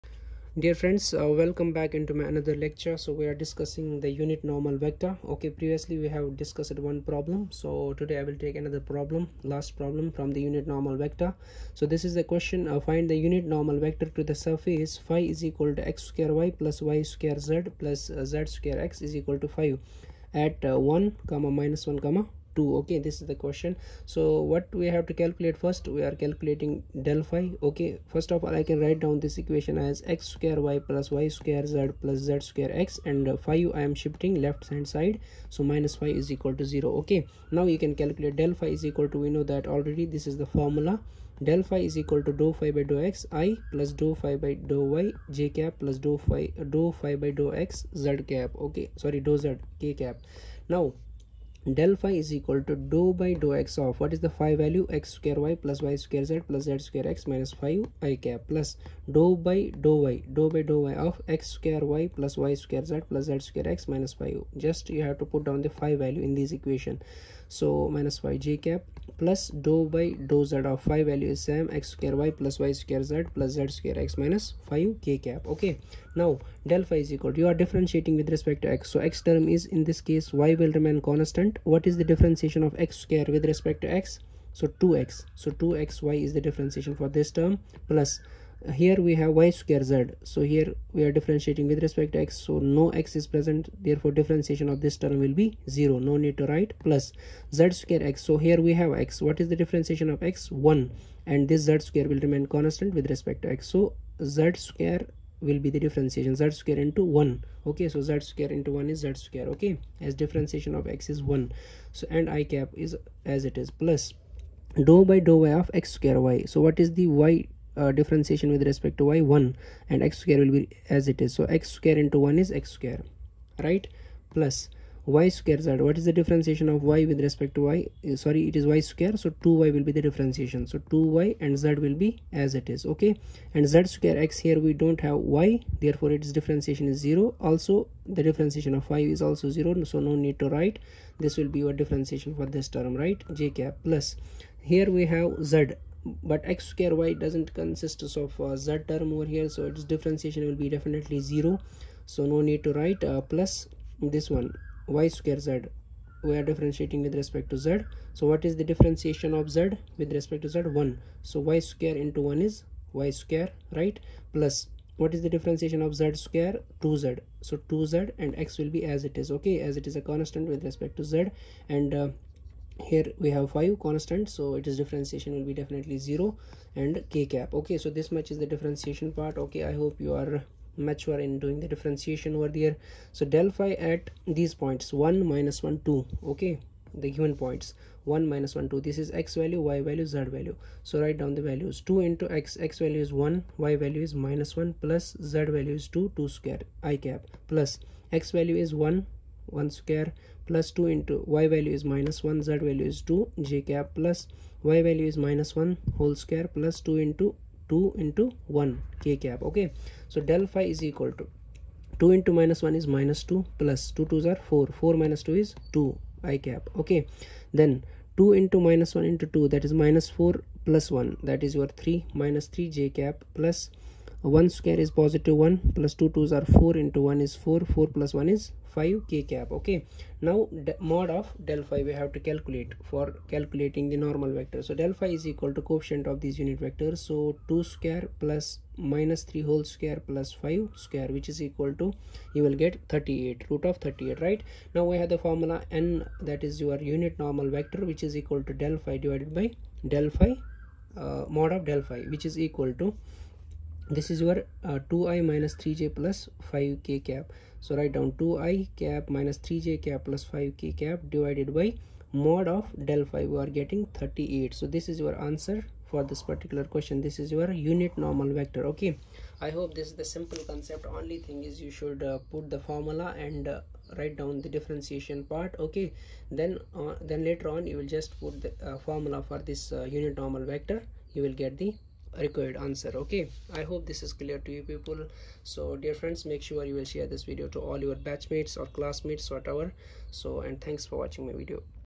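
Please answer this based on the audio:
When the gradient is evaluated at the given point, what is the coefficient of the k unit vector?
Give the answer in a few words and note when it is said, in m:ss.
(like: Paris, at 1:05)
5, at 3:47.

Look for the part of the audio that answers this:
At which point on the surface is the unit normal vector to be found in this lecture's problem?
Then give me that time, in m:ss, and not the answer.
0:20.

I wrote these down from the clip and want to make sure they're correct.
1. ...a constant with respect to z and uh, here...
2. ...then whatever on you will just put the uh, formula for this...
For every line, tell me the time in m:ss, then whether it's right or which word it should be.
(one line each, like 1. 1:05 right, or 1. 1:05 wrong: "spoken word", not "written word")
1. 2:49 right
2. 4:37 wrong: "later", not "whatever".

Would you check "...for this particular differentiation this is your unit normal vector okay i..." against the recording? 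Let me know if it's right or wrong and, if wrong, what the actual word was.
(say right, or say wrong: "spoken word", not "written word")
wrong: "question", not "differentiation".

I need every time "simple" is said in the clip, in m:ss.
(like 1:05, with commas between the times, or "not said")
4:30.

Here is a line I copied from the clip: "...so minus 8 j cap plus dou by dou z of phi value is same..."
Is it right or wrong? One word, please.
wrong.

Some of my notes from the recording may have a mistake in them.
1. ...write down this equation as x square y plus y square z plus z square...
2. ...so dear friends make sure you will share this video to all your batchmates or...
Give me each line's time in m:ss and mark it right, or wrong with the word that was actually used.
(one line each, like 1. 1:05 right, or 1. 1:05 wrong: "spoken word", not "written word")
1. 0:28 right
2. 4:45 right.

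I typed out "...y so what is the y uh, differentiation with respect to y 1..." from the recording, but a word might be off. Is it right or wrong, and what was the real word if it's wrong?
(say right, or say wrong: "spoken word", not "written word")
right.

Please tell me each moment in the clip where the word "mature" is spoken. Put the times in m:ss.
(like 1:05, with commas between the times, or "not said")
3:00.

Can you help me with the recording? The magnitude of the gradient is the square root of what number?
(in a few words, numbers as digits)
38.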